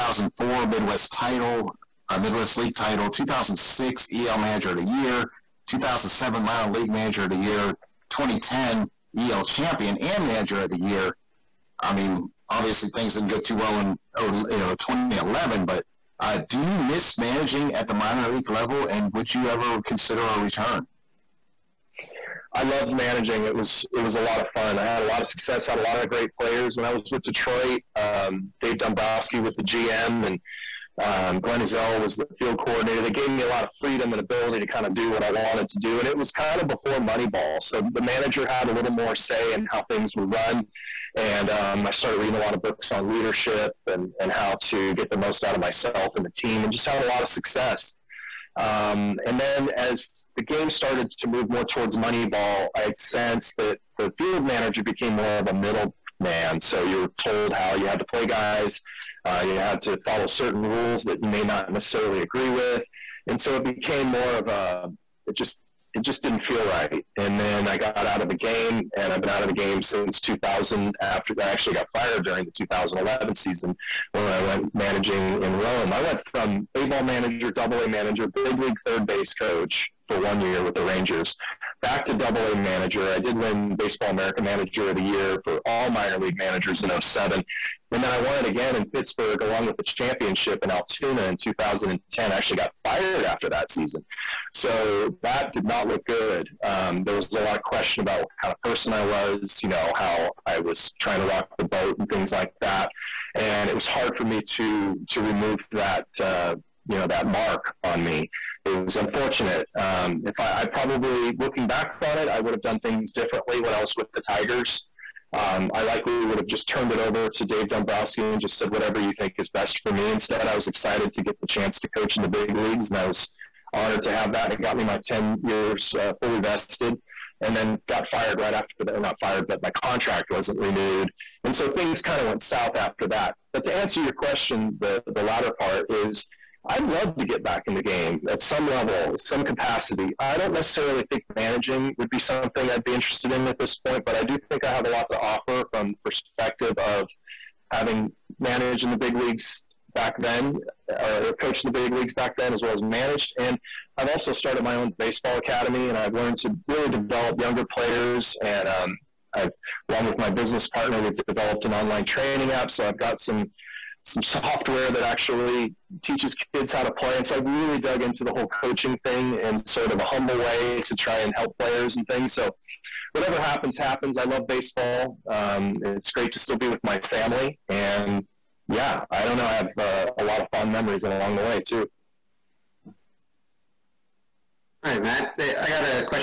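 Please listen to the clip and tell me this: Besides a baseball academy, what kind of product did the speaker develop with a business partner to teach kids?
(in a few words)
online training app.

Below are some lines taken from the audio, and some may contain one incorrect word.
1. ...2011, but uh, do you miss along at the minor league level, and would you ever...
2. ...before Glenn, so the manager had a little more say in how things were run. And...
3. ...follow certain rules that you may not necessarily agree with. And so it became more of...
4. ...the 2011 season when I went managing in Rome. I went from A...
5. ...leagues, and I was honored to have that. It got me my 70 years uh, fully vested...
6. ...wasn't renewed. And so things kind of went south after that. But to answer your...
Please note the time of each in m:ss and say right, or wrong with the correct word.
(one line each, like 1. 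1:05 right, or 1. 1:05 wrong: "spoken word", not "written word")
1. 0:14 wrong: "managing", not "along"
2. 0:36 wrong: "Moneyball", not "Glenn"
3. 0:59 right
4. 1:12 right
5. 2:02 wrong: "10", not "70"
6. 2:10 right.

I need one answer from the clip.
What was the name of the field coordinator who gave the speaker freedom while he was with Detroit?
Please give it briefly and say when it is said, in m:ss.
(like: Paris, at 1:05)
Glenn Ezell, at 0:31.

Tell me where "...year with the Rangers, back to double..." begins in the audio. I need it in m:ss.
1:20.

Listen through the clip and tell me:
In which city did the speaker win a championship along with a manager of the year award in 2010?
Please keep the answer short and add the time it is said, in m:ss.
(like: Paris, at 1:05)
Altoona, at 1:30.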